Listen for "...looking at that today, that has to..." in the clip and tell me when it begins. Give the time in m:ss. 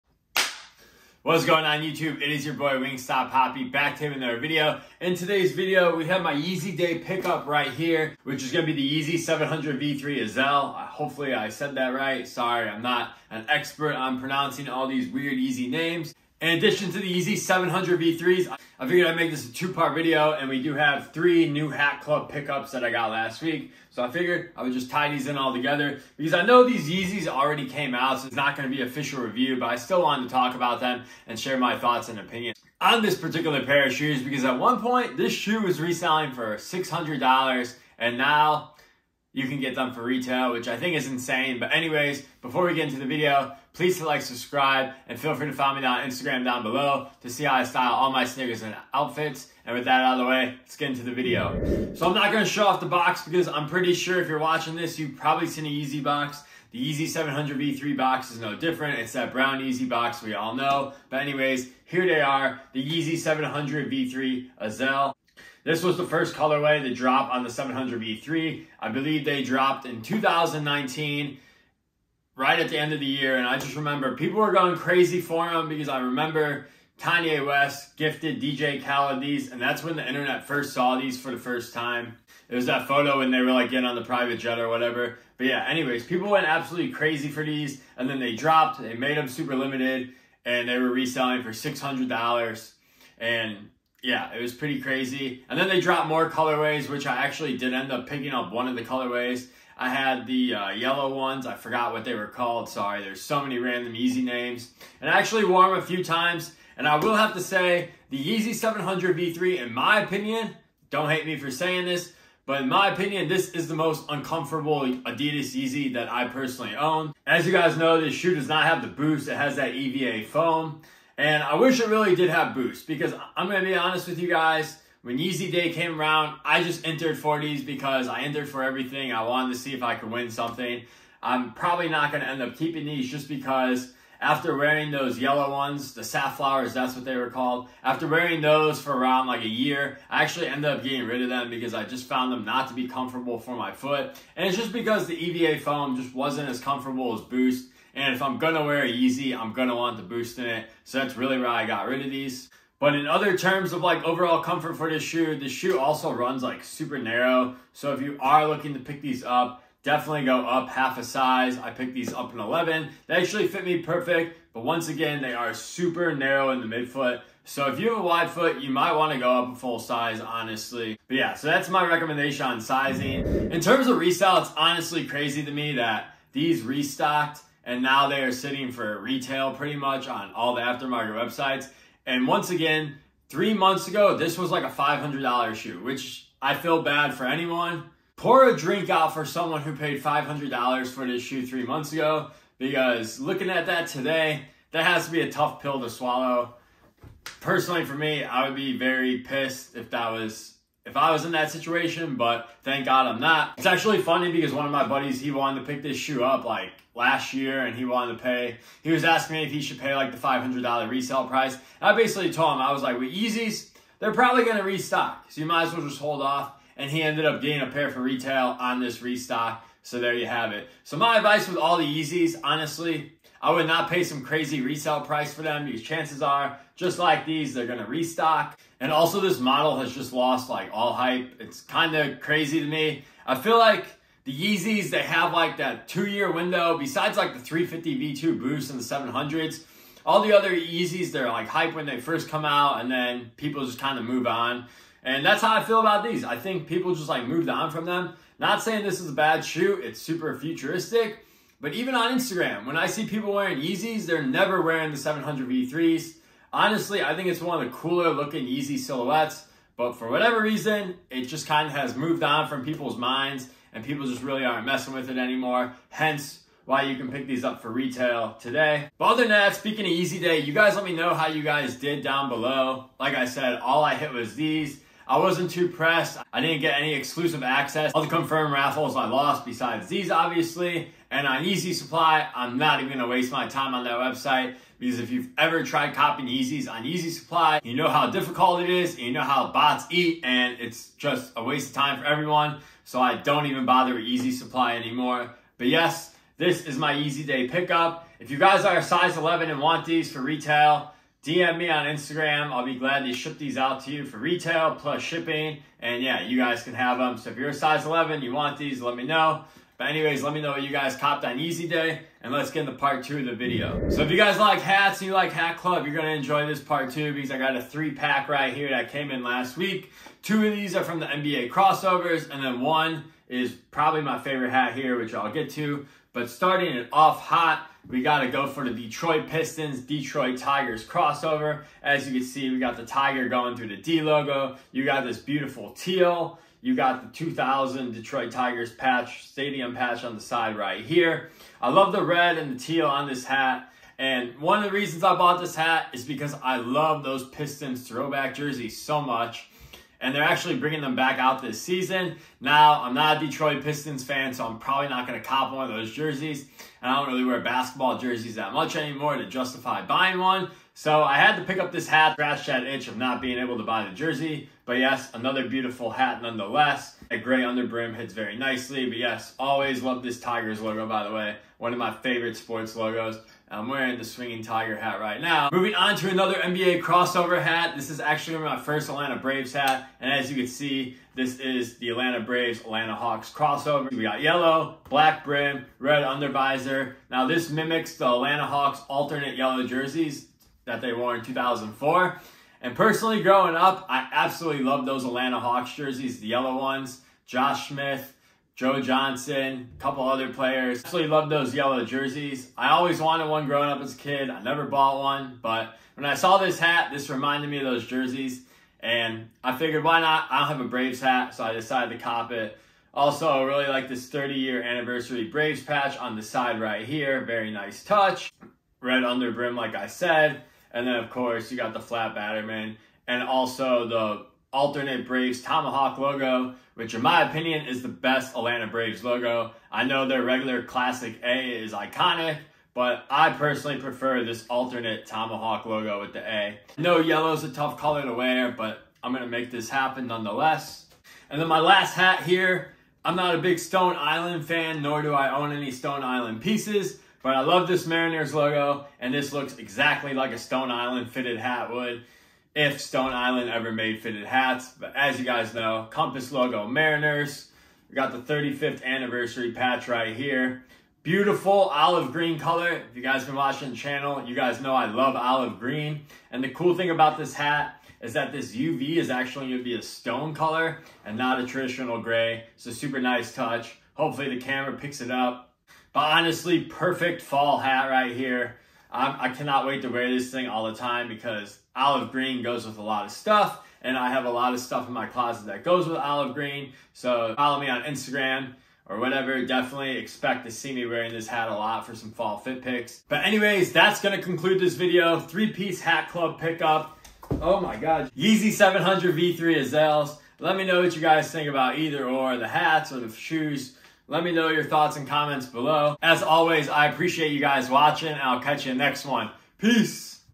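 3:13.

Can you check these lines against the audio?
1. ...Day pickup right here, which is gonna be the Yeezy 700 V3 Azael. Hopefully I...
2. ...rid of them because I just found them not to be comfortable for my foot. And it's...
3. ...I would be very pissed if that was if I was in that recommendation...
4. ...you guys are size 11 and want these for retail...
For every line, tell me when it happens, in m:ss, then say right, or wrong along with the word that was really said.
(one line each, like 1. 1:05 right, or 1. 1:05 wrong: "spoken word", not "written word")
1. 0:06 right
2. 2:21 right
3. 3:18 wrong: "situation", not "recommendation"
4. 4:58 right.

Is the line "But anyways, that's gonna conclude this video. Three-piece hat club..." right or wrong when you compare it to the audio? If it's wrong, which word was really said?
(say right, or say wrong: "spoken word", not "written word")
right.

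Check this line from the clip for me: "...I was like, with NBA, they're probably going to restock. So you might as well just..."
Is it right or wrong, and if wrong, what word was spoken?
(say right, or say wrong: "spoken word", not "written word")
wrong: "Yeezys", not "NBA".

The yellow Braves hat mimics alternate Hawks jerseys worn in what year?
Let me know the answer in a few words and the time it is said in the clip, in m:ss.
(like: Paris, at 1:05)
2004, at 6:31.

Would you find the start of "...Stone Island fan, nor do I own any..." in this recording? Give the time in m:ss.
7:23.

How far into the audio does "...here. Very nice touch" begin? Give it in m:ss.
6:56.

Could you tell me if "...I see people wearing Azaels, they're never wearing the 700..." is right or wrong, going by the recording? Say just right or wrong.
wrong.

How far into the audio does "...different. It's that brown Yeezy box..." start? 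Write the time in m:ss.
0:58.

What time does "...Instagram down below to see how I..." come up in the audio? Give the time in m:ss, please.
0:46.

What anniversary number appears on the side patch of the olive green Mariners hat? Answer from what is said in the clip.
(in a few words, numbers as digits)
35th.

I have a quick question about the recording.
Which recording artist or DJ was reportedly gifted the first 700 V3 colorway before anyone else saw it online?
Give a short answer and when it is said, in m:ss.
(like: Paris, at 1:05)
DJ Khaled, at 1:18.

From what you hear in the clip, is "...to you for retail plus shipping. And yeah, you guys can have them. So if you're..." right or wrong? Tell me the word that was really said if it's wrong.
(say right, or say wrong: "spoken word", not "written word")
right.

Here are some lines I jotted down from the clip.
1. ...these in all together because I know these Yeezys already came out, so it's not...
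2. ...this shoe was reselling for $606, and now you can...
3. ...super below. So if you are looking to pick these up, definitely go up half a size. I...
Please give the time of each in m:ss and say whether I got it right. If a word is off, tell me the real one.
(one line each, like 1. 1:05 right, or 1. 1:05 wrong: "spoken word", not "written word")
1. 0:25 right
2. 0:35 wrong: "600", not "606"
3. 2:36 wrong: "narrow", not "below".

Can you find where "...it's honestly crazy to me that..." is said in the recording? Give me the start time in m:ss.
2:54.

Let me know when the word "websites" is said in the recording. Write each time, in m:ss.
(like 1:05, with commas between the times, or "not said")
3:01, 4:43.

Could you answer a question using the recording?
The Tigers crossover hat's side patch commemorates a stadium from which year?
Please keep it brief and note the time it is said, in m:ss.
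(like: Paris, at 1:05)
2000, at 5:37.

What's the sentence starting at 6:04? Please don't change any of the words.
But yes, another beautiful hat nonetheless.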